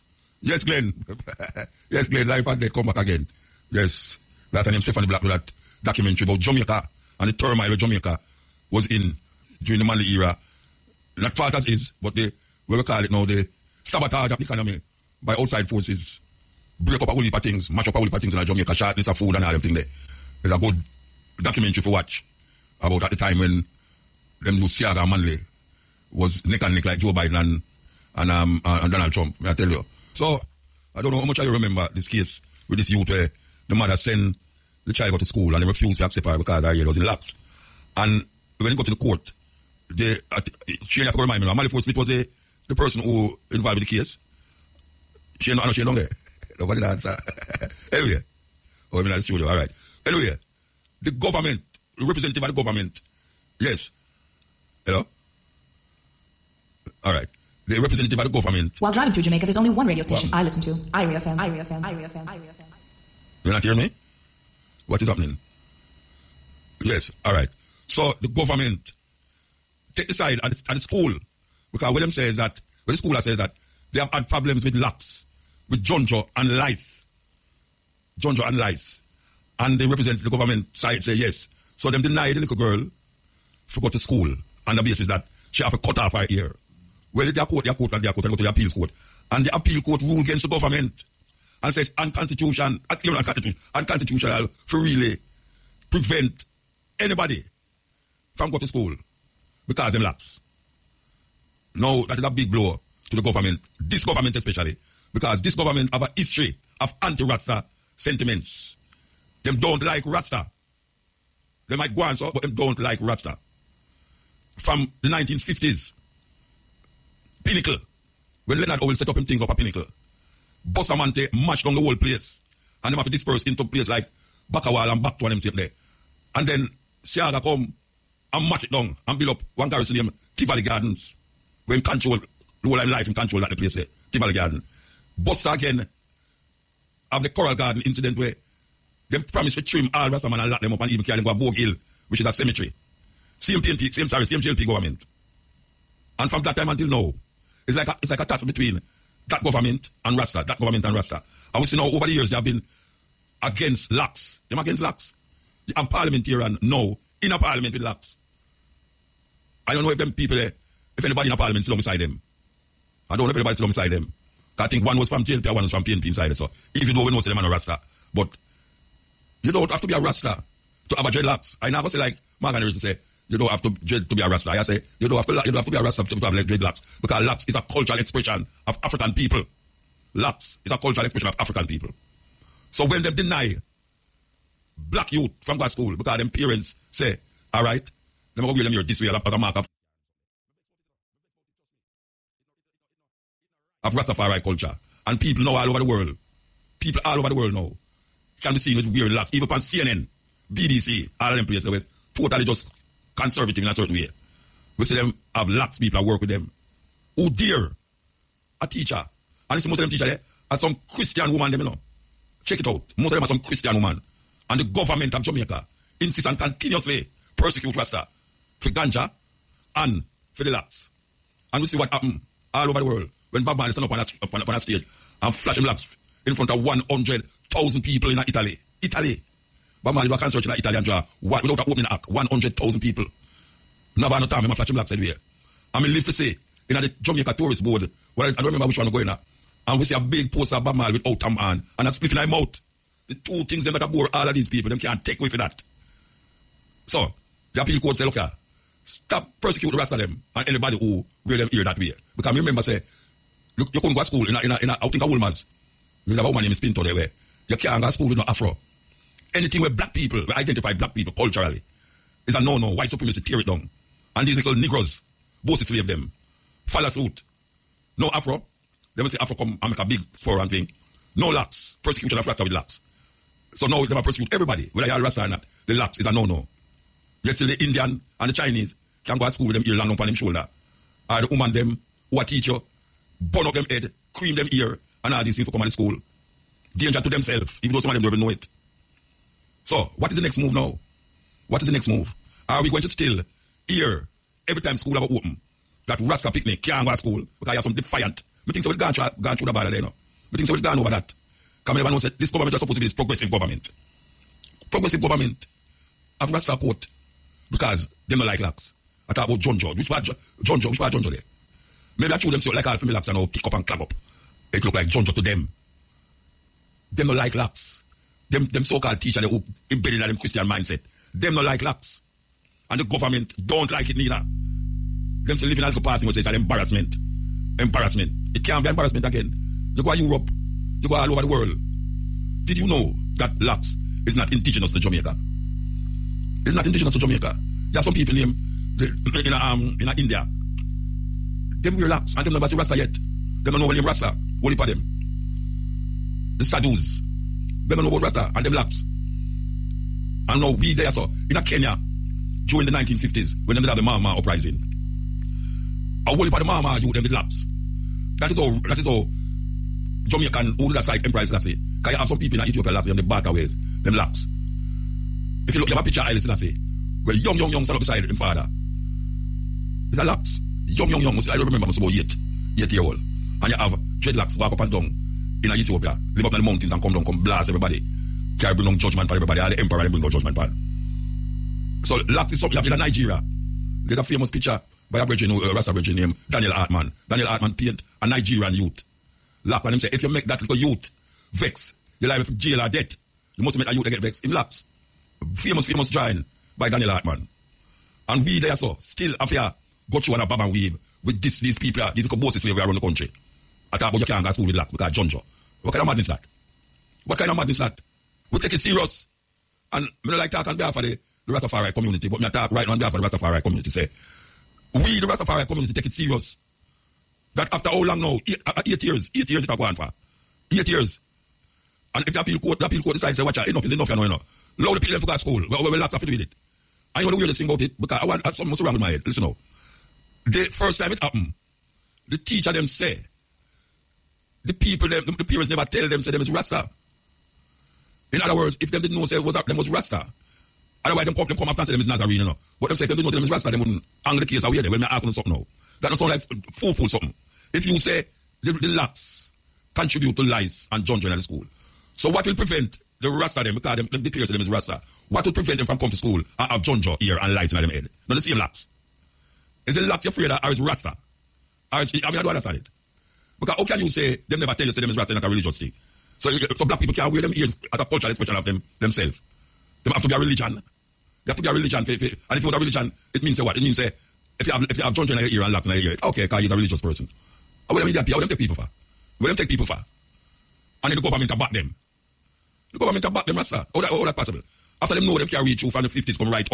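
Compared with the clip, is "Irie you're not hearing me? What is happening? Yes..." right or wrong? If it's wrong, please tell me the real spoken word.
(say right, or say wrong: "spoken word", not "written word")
right.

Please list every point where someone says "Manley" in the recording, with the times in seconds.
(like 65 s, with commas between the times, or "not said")
9 s, 25 s.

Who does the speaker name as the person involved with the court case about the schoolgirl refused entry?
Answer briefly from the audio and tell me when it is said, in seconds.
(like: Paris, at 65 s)
Molly Ford Smith, at 41 s.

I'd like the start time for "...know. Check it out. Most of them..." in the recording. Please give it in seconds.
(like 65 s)
211 s.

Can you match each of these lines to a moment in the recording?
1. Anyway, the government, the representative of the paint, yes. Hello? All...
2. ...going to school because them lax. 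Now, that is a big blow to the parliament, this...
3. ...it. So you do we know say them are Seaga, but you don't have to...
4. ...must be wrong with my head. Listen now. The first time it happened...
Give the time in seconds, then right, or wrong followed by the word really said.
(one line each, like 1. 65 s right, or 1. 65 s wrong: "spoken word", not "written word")
1. 50 s wrong: "government", not "paint"
2. 98 s wrong: "government", not "parliament"
3. 166 s wrong: "Rasta", not "Seaga"
4. 428 s right.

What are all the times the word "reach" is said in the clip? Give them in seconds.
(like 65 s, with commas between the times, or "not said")
485 s.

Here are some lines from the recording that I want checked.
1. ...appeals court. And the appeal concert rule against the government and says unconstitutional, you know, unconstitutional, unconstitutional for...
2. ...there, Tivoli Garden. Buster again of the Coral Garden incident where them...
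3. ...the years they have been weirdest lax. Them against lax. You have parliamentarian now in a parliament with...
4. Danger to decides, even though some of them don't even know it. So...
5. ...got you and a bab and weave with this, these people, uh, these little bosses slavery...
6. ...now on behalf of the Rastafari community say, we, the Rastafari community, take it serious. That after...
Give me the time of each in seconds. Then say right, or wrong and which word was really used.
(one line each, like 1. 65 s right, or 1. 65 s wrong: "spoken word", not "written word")
1. 88 s wrong: "court", not "concert"
2. 133 s right
3. 152 s wrong: "against", not "weirdest"
4. 286 s wrong: "themselves", not "decides"
5. 399 s right
6. 412 s right.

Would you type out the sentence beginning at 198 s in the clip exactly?
can be seen with wearing locks, even on CNN, BBC, all of them places where totally just conservative in a certain way.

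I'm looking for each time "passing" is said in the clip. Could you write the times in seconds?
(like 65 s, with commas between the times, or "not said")
325 s.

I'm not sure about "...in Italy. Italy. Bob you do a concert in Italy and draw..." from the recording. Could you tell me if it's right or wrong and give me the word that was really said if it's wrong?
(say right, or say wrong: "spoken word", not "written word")
right.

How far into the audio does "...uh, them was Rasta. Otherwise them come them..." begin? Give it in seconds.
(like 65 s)
439 s.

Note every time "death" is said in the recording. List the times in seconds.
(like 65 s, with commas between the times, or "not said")
2 s, 392 s.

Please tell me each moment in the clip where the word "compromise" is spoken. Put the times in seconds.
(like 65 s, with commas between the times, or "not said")
not said.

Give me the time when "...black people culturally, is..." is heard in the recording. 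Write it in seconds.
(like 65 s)
260 s.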